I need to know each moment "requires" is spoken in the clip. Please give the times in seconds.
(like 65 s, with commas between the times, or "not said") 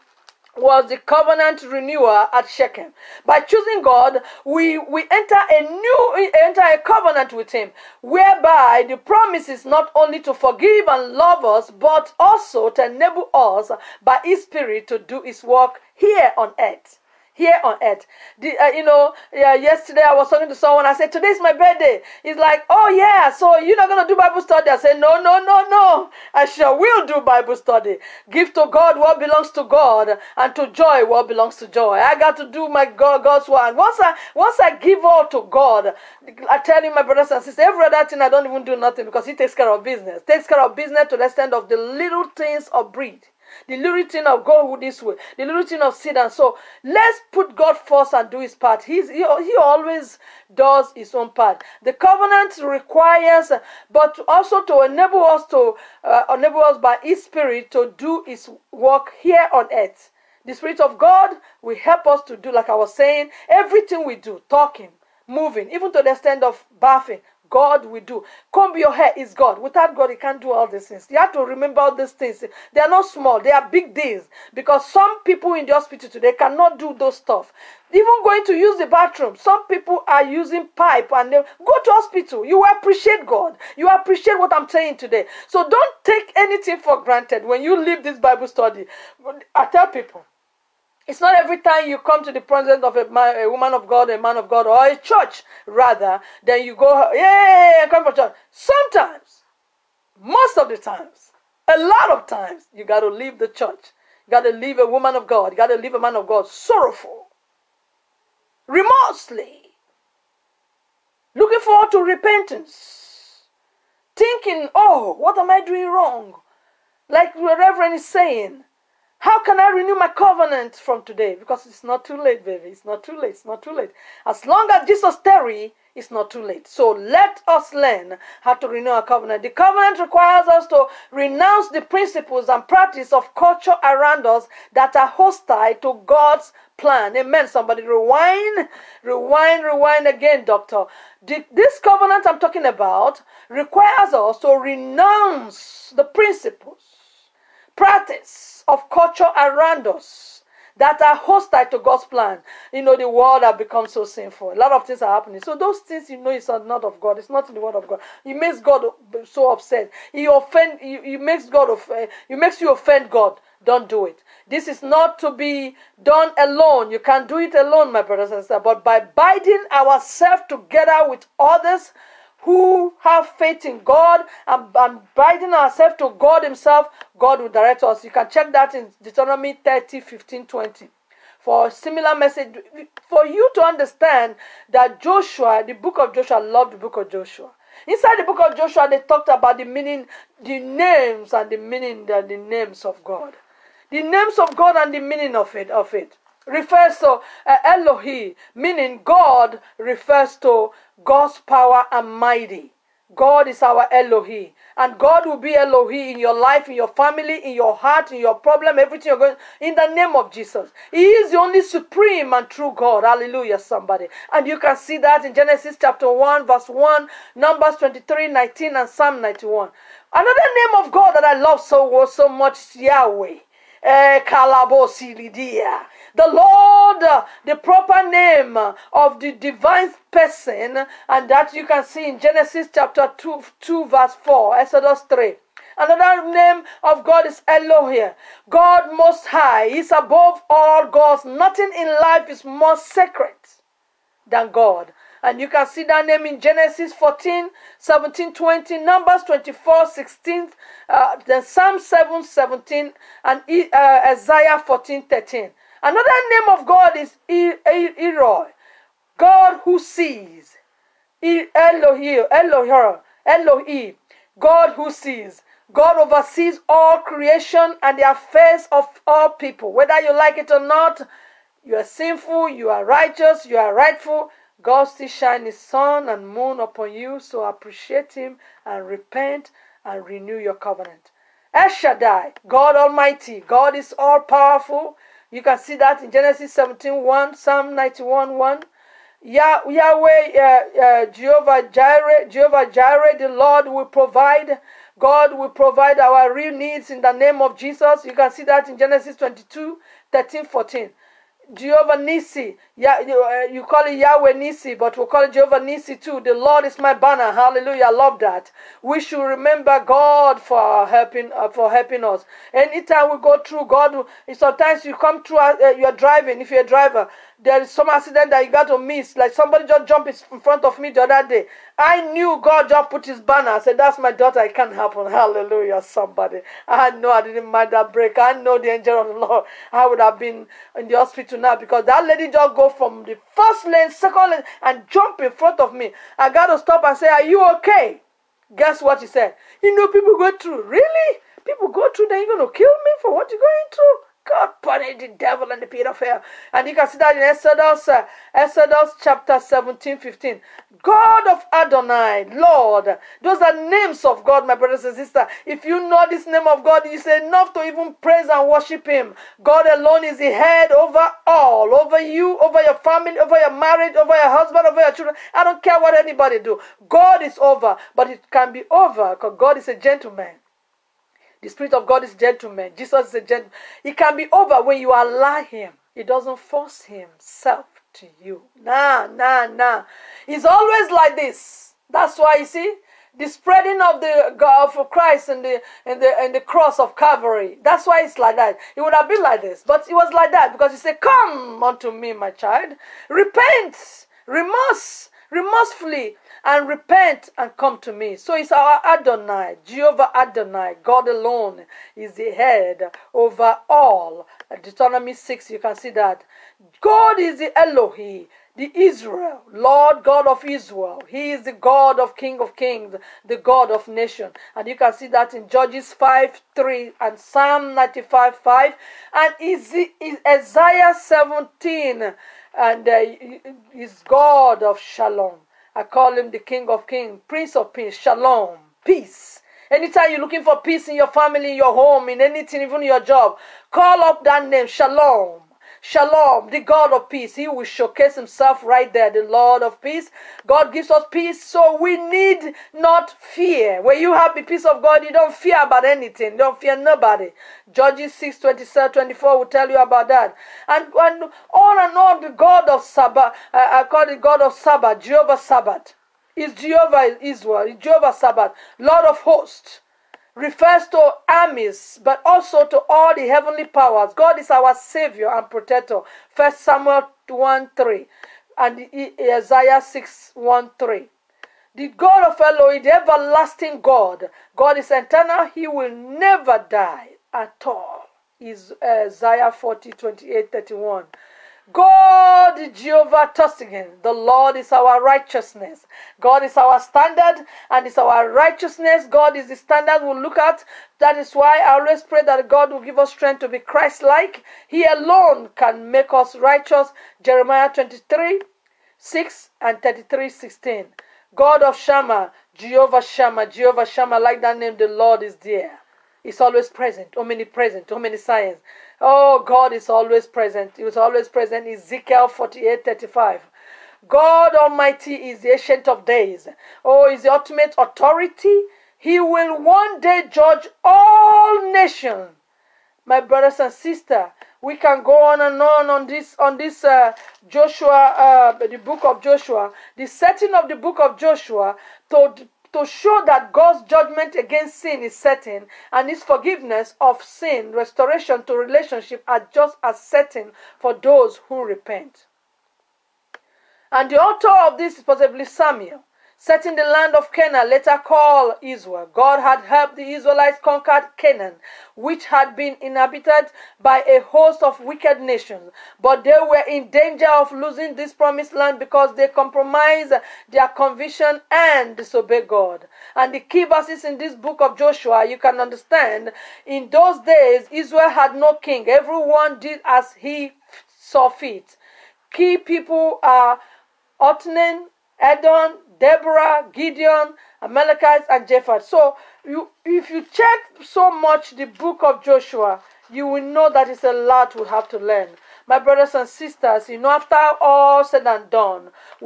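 52 s, 129 s, 143 s.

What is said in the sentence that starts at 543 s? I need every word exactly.
And the author of this is possibly Samuel set in the land of Canaan, later called Israel.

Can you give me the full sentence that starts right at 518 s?
He will one day judge all nations.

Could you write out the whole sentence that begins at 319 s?
Like somebody just jumped in front of me the other day.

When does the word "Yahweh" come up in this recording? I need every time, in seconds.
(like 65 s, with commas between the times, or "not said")
222 s, 289 s, 303 s.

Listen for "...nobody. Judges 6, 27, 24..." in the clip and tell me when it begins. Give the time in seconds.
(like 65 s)
446 s.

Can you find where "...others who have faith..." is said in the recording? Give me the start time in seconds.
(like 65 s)
171 s.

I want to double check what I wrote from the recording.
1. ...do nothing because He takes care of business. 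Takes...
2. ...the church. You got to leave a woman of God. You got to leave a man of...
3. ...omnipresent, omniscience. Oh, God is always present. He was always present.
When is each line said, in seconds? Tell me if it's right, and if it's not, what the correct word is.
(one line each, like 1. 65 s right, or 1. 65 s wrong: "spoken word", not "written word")
1. 38 s right
2. 103 s right
3. 507 s right.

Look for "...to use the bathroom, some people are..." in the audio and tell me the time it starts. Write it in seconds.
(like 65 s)
78 s.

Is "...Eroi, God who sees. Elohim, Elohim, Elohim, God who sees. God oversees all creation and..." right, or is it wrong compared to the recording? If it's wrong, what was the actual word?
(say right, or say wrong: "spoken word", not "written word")
right.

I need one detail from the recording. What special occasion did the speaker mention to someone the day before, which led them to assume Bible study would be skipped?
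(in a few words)
Birthday.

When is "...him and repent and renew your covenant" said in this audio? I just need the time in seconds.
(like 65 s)
278 s.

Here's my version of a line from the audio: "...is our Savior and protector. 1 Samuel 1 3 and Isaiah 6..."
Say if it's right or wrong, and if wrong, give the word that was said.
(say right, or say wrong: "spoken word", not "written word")
right.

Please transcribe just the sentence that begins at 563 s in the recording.
And the key verses in this book of Joshua, you can understand, in those days, Israel had no king.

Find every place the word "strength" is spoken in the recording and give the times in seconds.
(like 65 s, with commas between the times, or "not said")
493 s.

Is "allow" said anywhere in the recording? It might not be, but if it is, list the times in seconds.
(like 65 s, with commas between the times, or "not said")
374 s.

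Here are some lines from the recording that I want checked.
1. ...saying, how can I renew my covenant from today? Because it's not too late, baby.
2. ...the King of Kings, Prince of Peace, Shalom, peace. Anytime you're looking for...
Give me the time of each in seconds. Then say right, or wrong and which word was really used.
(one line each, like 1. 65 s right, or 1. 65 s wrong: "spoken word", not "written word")
1. 118 s right
2. 426 s right.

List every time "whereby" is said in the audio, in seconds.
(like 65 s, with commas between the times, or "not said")
8 s.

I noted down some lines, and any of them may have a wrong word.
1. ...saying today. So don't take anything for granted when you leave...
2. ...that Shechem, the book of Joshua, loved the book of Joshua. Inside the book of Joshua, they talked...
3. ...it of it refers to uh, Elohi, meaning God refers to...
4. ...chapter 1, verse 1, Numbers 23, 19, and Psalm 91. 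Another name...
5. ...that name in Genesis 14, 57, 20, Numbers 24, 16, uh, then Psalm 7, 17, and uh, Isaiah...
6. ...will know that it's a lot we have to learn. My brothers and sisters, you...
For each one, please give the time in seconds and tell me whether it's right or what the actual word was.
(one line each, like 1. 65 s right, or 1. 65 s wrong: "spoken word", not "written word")
1. 84 s right
2. 184 s wrong: "Joshua", not "Shechem"
3. 195 s right
4. 215 s right
5. 245 s wrong: "17", not "57"
6. 583 s right.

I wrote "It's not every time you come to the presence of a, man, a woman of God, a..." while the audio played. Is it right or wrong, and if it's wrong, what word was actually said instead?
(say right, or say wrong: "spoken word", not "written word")
right.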